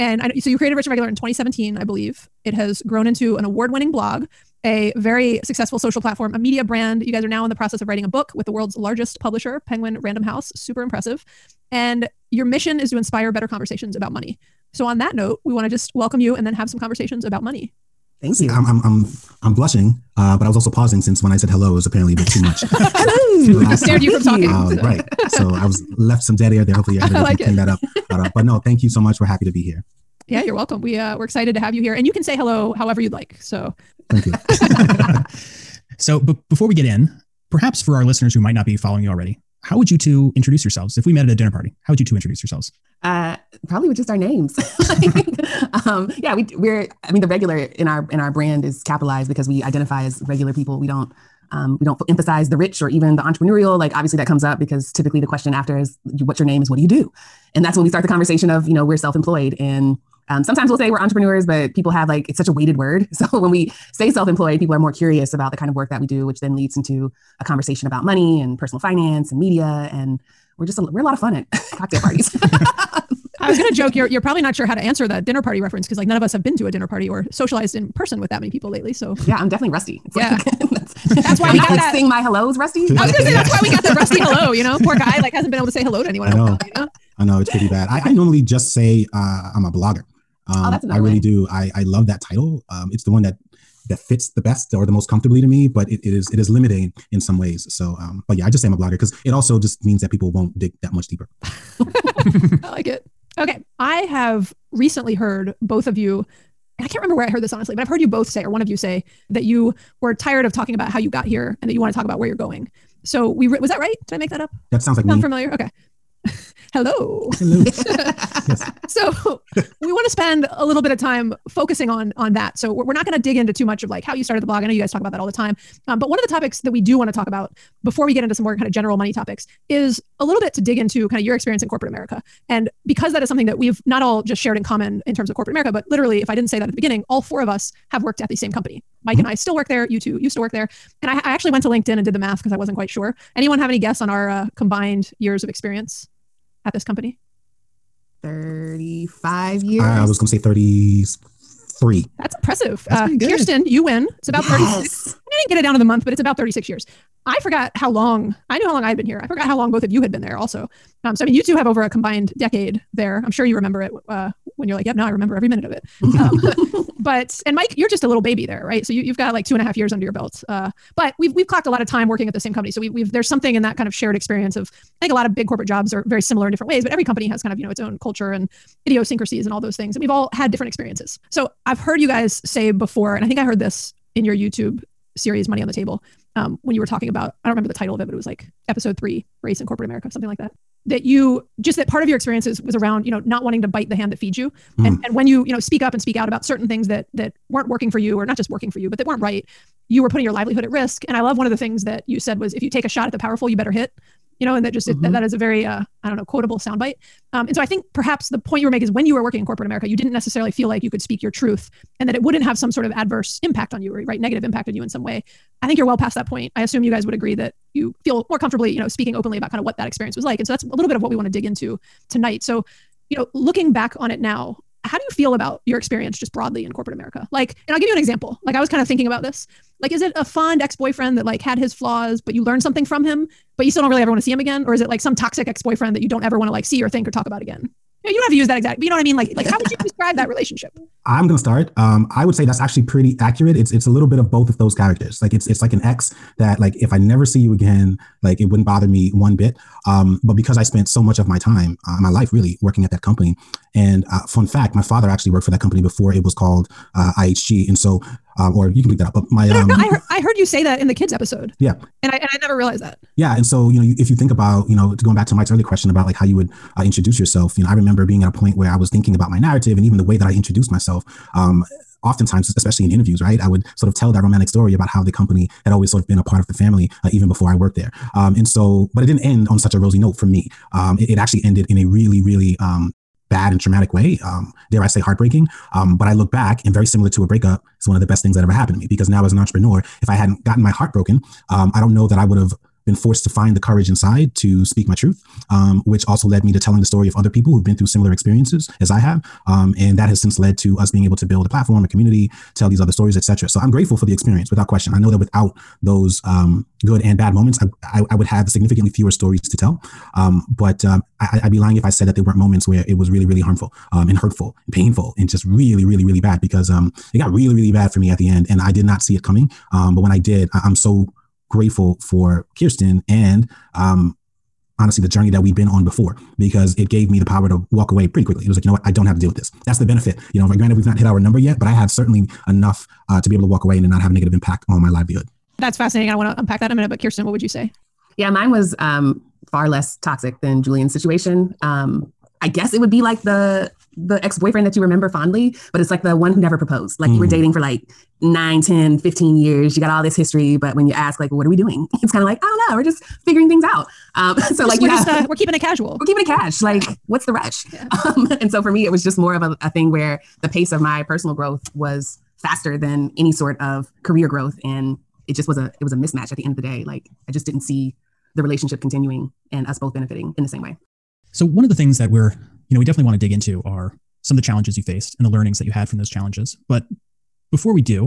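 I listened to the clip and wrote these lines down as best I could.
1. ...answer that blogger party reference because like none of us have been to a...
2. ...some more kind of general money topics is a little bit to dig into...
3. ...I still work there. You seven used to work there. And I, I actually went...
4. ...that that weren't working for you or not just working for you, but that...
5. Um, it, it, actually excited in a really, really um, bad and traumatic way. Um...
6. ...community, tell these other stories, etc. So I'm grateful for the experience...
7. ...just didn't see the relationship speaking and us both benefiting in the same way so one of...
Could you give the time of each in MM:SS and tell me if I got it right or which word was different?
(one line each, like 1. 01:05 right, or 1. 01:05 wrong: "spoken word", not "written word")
1. 01:14 wrong: "dinner", not "blogger"
2. 02:08 right
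3. 02:19 wrong: "two", not "seven"
4. 03:16 right
5. 04:40 wrong: "ended", not "excited"
6. 05:01 right
7. 06:07 wrong: "continuing", not "speaking".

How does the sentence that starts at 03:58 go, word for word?
Yeah, you don't have to use that exact, but you know what I mean?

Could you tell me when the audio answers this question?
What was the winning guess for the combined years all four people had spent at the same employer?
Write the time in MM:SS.
02:28.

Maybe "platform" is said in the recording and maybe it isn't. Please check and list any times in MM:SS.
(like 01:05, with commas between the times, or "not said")
00:06, 05:01.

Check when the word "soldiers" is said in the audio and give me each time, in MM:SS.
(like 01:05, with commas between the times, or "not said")
not said.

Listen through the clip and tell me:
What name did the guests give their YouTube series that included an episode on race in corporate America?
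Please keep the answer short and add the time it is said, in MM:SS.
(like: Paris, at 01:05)
Money on the Table, at 03:05.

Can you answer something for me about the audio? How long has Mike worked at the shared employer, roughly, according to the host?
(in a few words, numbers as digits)
two and a half years.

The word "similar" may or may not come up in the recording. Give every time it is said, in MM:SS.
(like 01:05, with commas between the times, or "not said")
02:56, 04:46, 04:57.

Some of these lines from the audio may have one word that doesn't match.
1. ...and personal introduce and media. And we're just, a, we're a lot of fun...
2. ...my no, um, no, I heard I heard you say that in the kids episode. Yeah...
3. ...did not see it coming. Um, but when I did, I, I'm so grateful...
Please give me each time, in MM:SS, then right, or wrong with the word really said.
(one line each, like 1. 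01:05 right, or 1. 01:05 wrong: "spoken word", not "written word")
1. 01:08 wrong: "finance", not "introduce"
2. 04:19 right
3. 05:18 right.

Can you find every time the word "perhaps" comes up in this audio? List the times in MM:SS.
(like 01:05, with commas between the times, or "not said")
00:37, 03:27.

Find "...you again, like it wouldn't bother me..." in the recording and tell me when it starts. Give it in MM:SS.
04:07.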